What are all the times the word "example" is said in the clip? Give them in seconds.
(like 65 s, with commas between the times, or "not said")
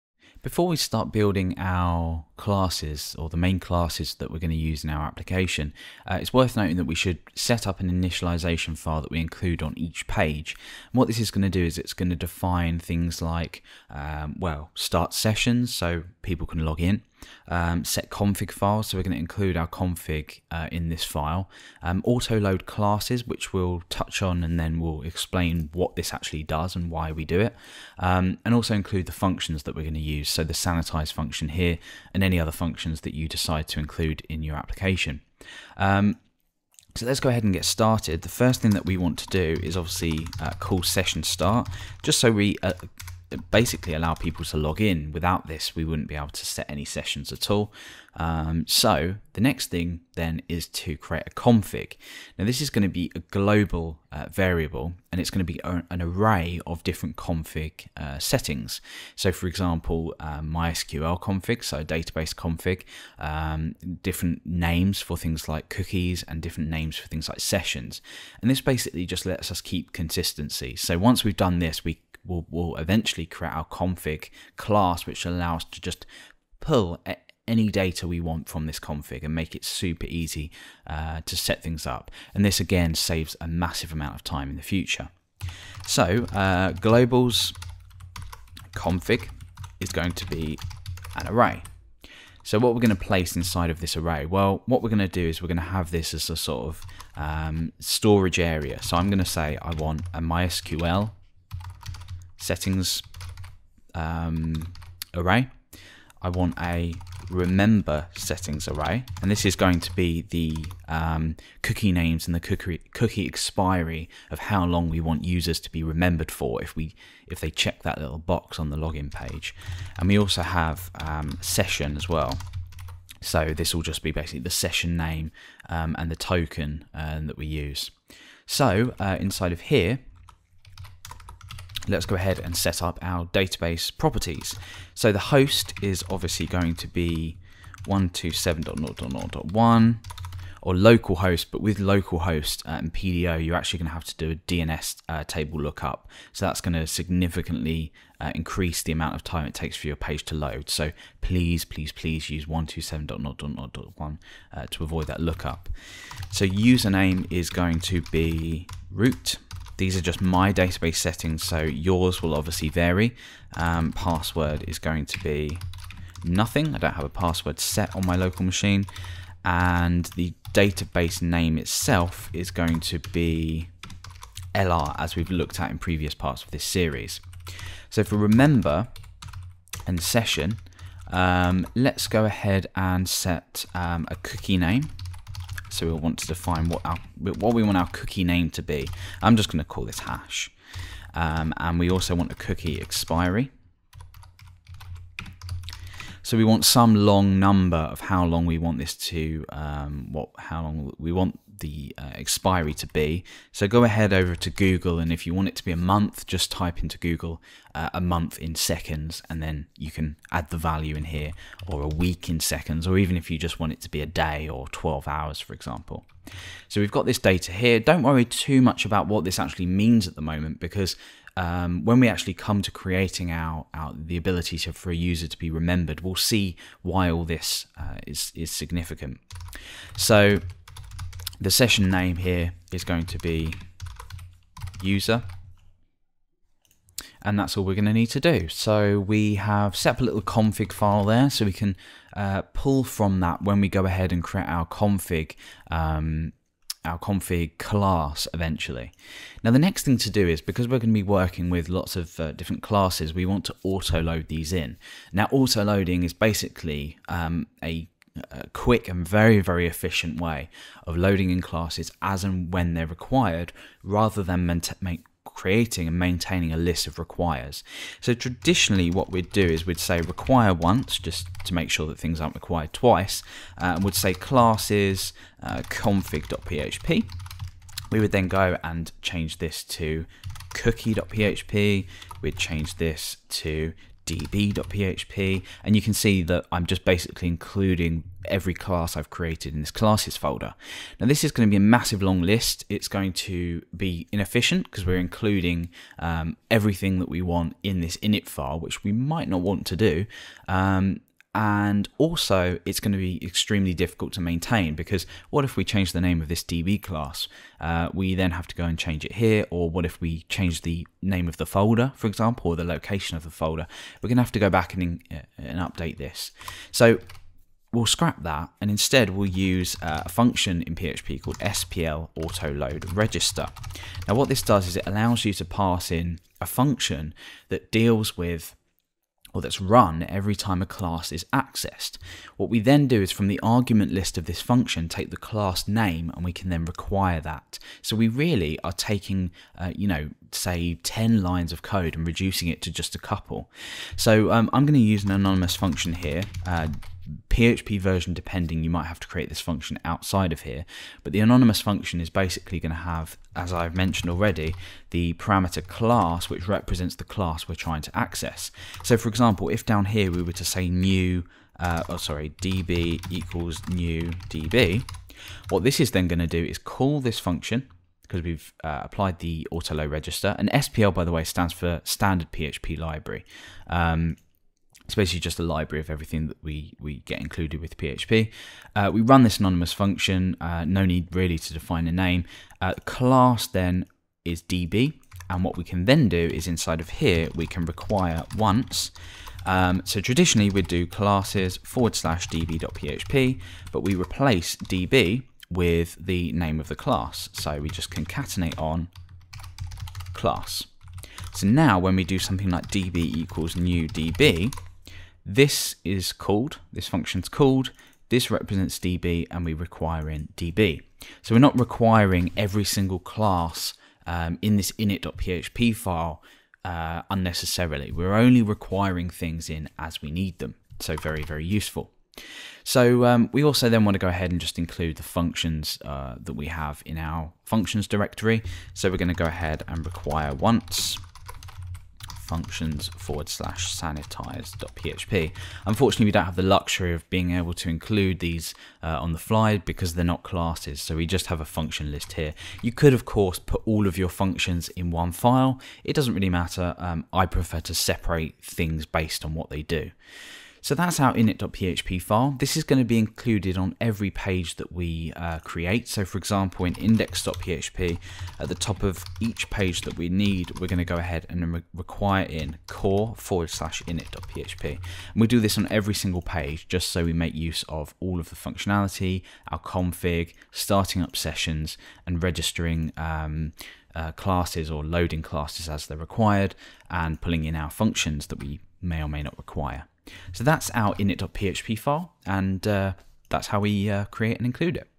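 59 s, 215 s, 312 s, 359 s, 456 s.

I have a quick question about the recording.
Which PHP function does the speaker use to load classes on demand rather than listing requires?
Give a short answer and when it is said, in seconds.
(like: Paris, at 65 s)
SPL autoload register, at 321 s.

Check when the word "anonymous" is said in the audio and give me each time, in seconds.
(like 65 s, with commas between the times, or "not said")
345 s, 351 s, 379 s.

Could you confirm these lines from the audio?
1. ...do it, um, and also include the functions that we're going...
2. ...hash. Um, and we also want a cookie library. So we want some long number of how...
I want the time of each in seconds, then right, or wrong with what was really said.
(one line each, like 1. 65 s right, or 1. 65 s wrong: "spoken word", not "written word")
1. 27 s right
2. 189 s wrong: "expiry", not "library".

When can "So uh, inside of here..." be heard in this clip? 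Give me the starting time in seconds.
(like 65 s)
128 s.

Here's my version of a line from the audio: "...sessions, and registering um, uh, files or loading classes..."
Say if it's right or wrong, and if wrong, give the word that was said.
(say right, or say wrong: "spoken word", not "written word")
wrong: "classes", not "files".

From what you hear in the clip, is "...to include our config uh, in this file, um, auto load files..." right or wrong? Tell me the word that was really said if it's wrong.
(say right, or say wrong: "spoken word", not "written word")
wrong: "classes", not "files".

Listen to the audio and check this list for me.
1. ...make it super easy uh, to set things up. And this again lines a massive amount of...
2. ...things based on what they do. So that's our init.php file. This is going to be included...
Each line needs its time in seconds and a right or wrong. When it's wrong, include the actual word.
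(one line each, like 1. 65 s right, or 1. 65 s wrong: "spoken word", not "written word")
1. 79 s wrong: "saves", not "lines"
2. 448 s right.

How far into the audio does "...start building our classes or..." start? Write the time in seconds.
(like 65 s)
0 s.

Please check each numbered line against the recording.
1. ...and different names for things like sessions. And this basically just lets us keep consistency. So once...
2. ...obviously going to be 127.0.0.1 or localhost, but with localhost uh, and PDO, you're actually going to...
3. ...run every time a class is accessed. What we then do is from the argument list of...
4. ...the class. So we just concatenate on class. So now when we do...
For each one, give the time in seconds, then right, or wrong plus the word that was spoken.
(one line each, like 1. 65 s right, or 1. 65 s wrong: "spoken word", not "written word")
1. 66 s right
2. 136 s right
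3. 329 s right
4. 396 s right.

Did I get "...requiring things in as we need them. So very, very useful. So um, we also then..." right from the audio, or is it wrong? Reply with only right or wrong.
right.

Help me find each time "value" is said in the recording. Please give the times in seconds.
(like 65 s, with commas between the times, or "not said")
210 s.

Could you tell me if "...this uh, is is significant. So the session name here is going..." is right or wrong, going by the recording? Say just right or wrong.
right.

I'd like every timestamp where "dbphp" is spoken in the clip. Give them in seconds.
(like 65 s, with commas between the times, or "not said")
284 s, 392 s.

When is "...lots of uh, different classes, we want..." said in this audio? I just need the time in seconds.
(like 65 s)
251 s.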